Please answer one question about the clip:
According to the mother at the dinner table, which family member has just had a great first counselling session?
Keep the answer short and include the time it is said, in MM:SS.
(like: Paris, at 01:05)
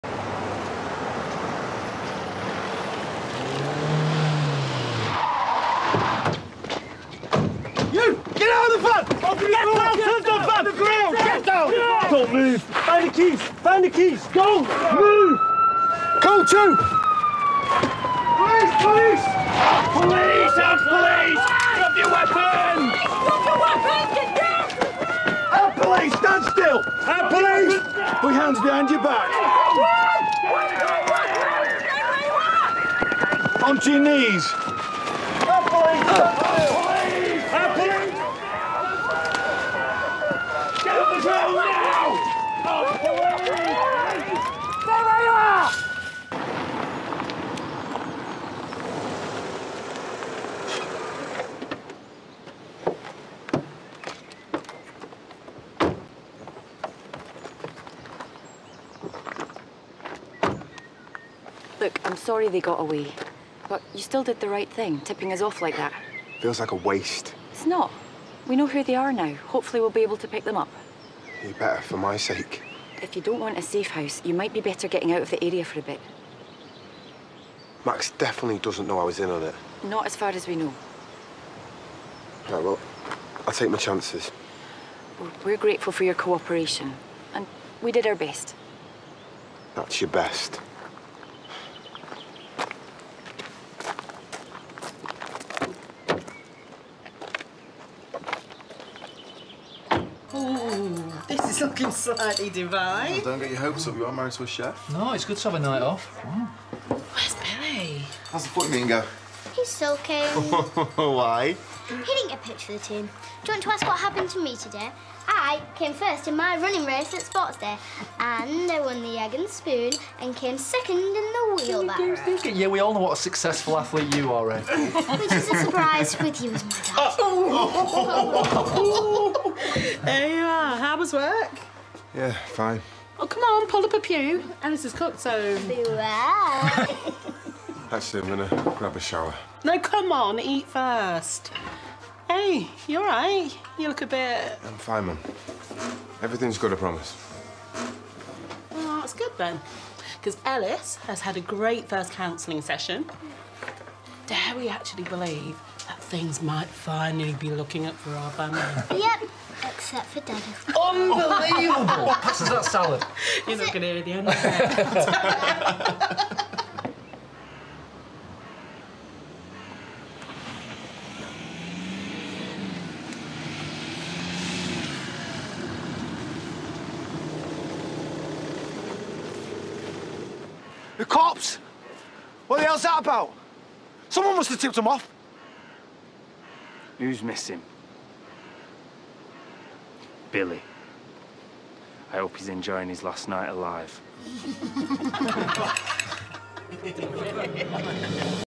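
Ellis, at 02:30.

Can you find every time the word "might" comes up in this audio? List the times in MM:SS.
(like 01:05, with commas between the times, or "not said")
01:14, 02:36.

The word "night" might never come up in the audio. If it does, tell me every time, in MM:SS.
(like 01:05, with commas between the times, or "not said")
01:45, 03:13.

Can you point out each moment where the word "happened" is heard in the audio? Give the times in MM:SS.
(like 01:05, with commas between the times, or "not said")
01:53.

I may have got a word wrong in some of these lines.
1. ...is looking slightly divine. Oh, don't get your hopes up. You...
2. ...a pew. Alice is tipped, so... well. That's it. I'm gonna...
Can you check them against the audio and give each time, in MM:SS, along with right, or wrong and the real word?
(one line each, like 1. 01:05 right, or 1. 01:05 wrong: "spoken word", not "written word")
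1. 01:41 right
2. 02:13 wrong: "cooked", not "tipped".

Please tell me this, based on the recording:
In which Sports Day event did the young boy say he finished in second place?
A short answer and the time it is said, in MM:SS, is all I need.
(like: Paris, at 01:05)
wheelbarrow, at 02:01.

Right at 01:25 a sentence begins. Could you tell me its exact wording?
we're grateful for your cooperation, and we did our best.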